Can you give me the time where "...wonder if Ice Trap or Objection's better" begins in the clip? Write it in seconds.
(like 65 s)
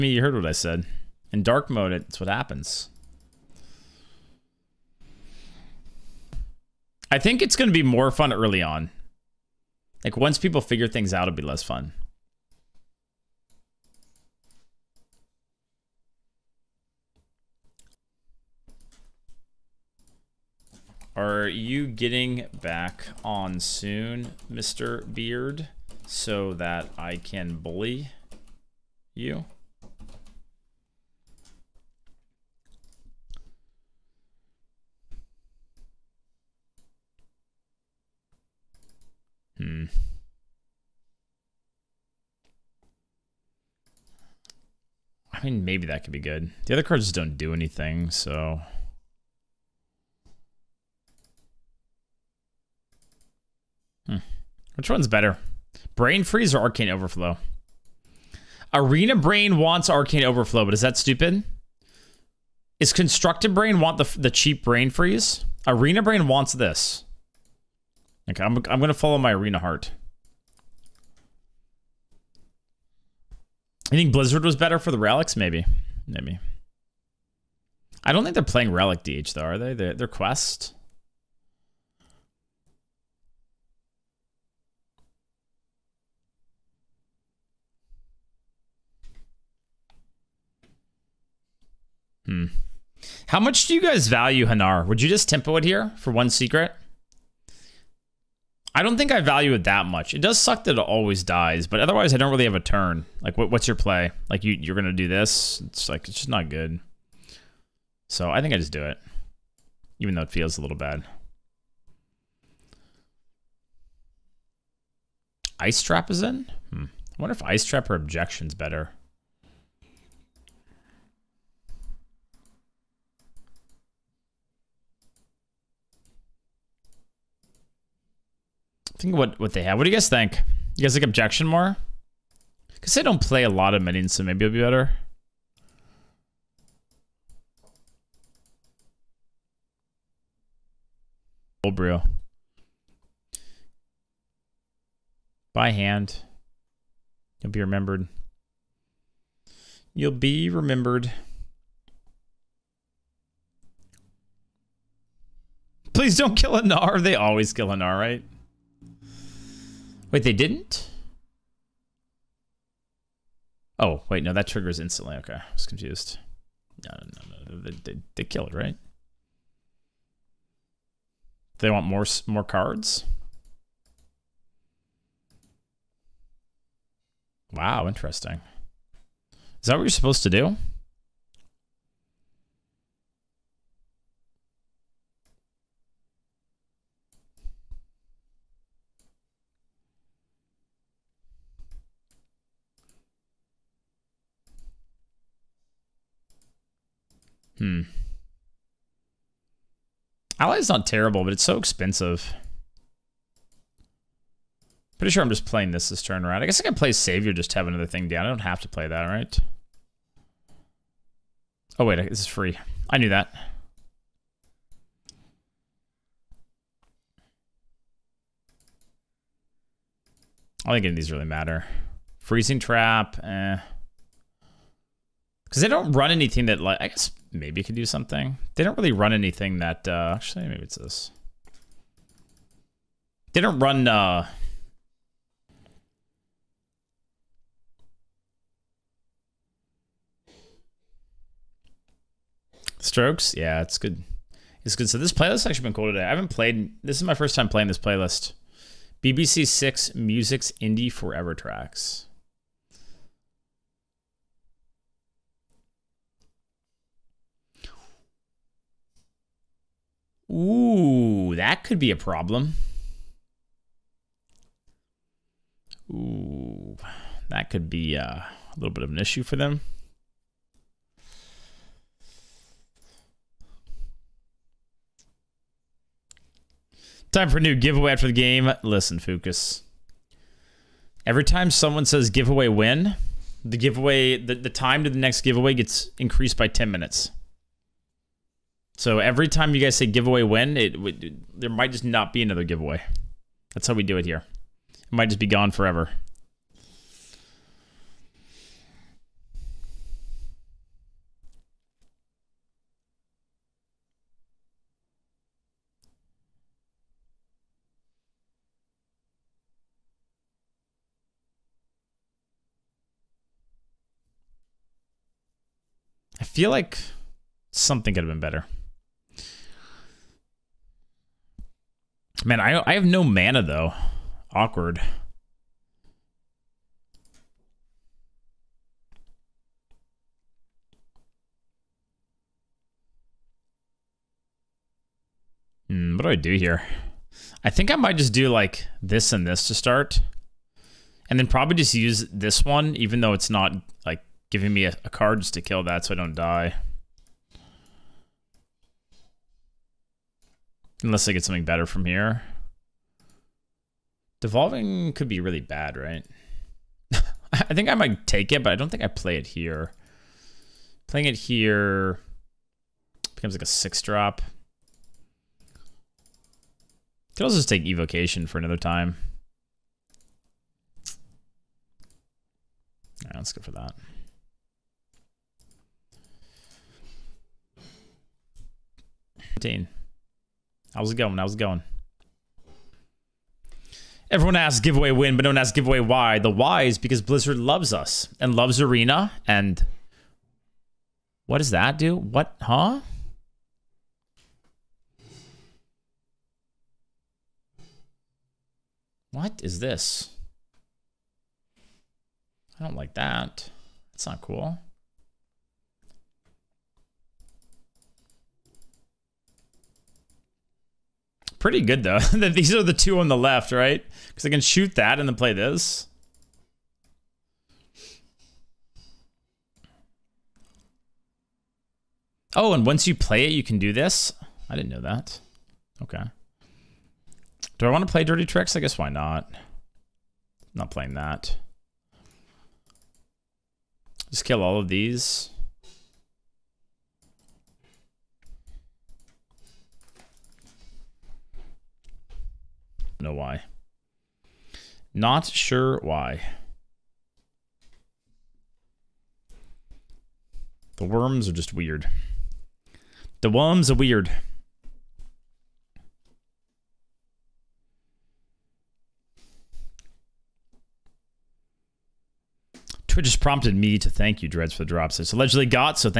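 117 s.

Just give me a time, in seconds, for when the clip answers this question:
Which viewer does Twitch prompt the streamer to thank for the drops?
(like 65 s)
464 s.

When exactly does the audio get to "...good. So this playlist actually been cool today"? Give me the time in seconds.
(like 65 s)
244 s.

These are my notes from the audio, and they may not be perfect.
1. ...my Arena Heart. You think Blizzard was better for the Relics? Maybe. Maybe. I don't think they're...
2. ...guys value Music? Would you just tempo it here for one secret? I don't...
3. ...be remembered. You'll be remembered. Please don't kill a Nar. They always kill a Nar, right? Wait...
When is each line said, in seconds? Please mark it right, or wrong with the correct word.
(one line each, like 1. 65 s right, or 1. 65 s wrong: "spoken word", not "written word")
1. 69 s right
2. 93 s wrong: "Hanar", not "Music"
3. 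147 s right.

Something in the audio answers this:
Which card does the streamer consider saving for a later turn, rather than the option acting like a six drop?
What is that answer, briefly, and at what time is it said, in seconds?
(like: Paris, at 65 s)
Evocation, at 367 s.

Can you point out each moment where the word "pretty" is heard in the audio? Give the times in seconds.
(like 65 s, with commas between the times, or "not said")
204 s, 411 s.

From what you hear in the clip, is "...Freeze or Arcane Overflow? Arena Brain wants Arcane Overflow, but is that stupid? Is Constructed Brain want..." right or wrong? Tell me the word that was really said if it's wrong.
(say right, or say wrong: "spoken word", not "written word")
right.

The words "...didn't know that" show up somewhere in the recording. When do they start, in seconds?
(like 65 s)
424 s.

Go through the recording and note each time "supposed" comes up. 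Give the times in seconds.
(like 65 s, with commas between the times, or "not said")
179 s.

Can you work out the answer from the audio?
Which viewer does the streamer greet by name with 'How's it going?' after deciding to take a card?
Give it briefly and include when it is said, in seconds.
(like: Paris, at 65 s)
Dean, at 379 s.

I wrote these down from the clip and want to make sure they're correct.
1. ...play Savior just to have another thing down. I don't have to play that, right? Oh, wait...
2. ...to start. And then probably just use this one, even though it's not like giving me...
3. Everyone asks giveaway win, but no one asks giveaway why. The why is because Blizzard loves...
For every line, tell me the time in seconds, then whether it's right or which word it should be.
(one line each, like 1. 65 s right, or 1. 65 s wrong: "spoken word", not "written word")
1. 206 s right
2. 339 s right
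3. 384 s right.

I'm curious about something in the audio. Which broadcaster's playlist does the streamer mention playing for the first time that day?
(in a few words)
BBC 6 Music.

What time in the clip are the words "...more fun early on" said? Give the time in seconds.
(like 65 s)
7 s.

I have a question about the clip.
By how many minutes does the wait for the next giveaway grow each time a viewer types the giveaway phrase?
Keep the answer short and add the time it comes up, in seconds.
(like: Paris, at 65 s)
10 minutes, at 286 s.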